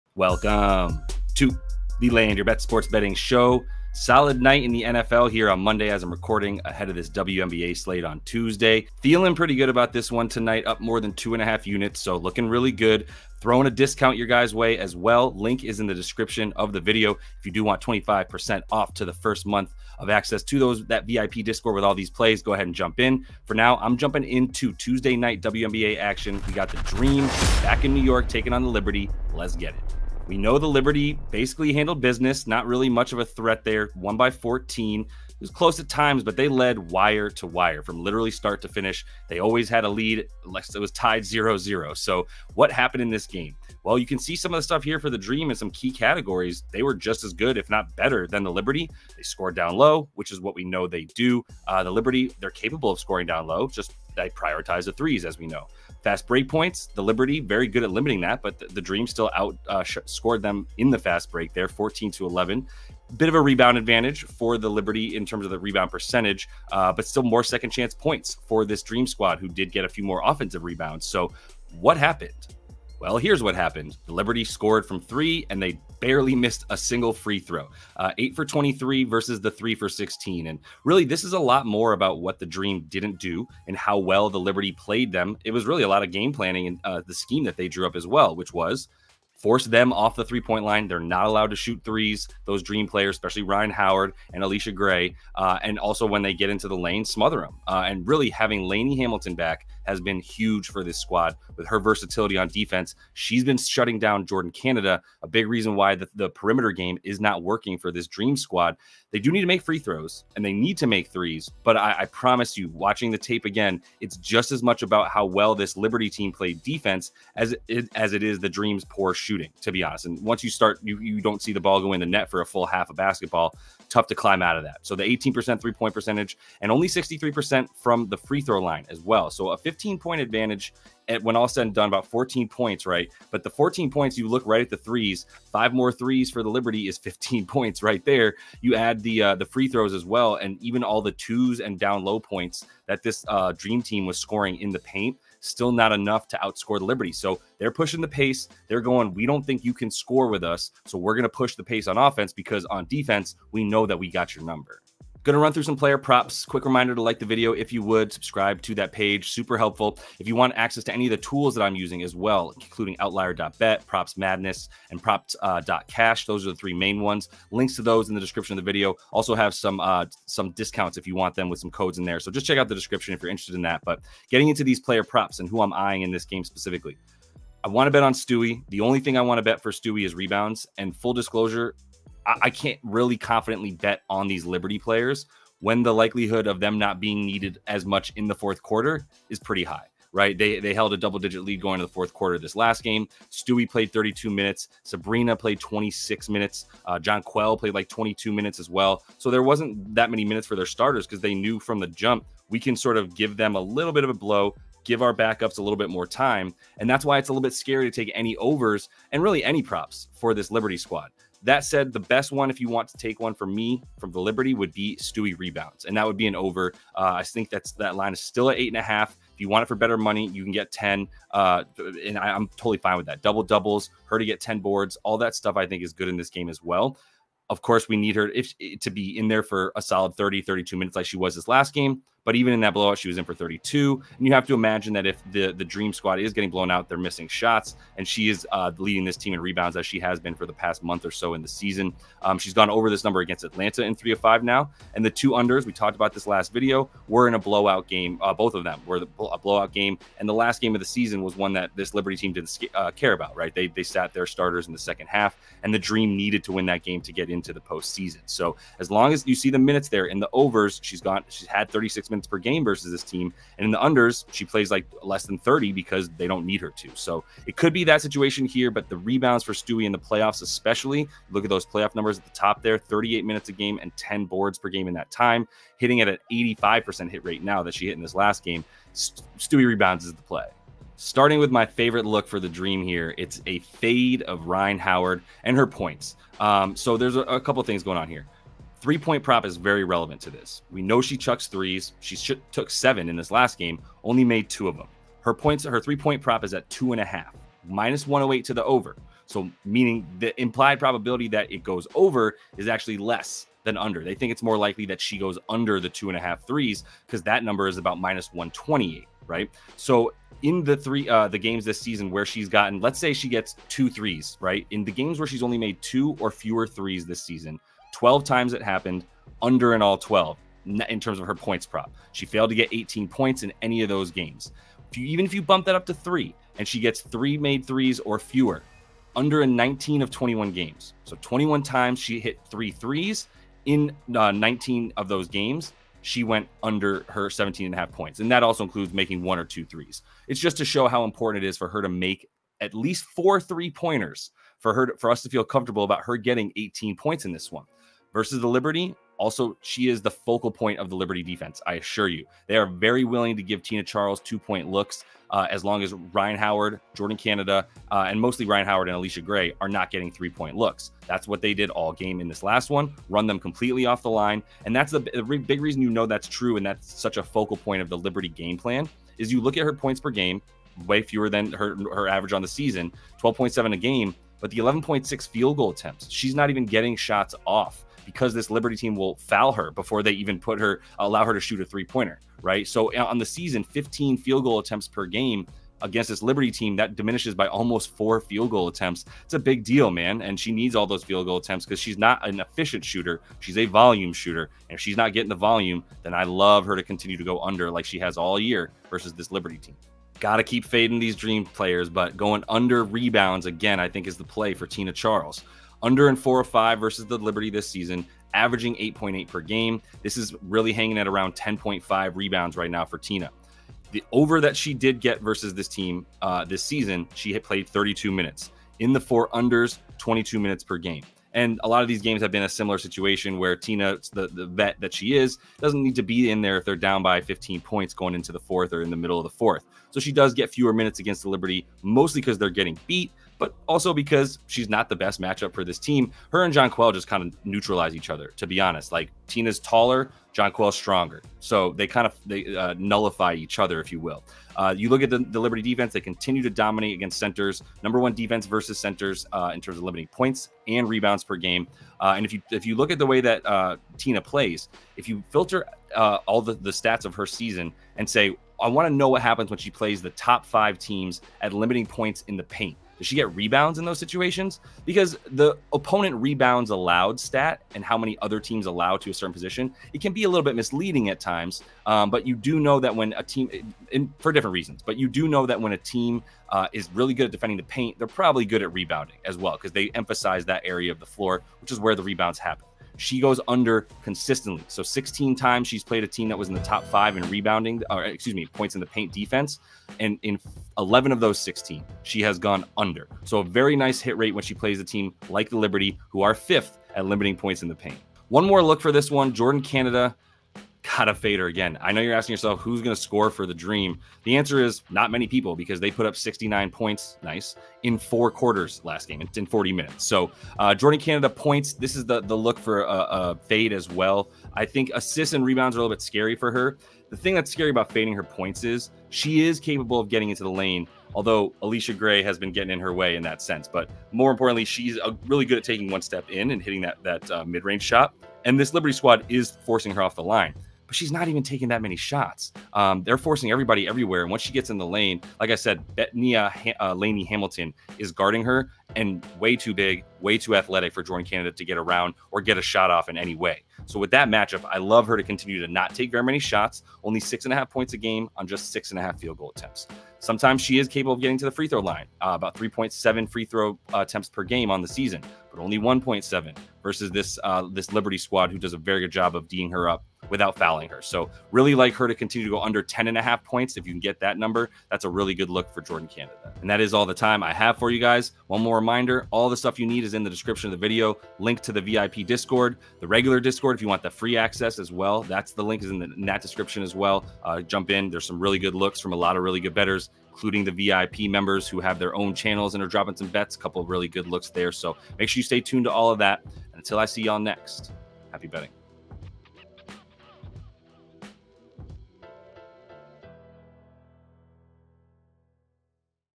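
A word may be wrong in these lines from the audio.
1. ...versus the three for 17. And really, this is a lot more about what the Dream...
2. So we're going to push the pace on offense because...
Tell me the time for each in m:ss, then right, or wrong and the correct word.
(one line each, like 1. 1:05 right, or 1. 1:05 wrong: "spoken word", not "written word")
1. 1:19 wrong: "16", not "17"
2. 2:30 right.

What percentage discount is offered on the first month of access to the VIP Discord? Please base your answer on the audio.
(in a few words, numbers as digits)
25%.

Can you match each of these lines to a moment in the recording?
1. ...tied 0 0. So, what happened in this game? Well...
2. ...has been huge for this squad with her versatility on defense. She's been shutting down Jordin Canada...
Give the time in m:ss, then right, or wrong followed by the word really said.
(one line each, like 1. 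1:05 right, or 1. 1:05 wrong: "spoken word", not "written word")
1. 0:40 right
2. 1:39 right.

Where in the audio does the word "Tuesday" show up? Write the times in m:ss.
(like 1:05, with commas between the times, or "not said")
0:08, 0:24.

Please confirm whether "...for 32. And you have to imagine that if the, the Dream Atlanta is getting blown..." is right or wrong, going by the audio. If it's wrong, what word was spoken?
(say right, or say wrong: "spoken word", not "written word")
wrong: "Squad", not "Atlanta".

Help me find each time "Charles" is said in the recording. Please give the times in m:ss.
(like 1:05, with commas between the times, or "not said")
5:53, 6:44.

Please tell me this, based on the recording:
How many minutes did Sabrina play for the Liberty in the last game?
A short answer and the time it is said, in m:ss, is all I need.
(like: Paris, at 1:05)
26, at 3:15.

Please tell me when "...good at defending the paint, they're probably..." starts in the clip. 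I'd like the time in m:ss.
7:57.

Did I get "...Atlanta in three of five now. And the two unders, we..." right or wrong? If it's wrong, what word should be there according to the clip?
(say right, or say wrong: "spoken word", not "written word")
right.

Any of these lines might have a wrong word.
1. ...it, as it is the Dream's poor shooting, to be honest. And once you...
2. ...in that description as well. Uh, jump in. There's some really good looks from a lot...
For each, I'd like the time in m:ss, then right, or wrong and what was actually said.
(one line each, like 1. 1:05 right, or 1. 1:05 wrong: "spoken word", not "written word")
1. 1:57 right
2. 9:36 right.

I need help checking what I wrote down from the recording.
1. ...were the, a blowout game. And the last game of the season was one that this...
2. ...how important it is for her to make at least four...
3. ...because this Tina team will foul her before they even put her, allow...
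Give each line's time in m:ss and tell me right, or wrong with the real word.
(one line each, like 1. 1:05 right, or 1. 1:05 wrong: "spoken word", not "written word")
1. 4:08 right
2. 5:40 right
3. 6:18 wrong: "Liberty", not "Tina".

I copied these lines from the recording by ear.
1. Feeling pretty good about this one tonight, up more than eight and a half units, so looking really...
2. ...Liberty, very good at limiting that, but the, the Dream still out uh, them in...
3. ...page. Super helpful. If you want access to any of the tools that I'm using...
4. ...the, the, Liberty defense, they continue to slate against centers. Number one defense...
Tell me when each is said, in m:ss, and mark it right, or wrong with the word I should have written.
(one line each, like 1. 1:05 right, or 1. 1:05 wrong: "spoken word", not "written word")
1. 0:09 wrong: "two", not "eight"
2. 0:57 right
3. 2:38 right
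4. 7:25 wrong: "dominate", not "slate".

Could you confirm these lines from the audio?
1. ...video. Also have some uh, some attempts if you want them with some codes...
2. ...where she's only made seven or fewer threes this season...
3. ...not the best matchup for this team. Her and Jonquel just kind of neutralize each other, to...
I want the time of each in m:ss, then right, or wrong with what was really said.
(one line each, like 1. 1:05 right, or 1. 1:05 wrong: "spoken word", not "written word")
1. 2:48 wrong: "discounts", not "attempts"
2. 5:15 wrong: "two", not "seven"
3. 7:14 right.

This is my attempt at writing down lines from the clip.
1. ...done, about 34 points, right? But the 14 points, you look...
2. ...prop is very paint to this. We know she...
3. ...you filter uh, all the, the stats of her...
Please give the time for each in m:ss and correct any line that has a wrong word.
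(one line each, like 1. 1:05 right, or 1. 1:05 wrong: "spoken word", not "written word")
1. 2:11 wrong: "14", not "34"
2. 4:49 wrong: "relevant", not "paint"
3. 7:35 right.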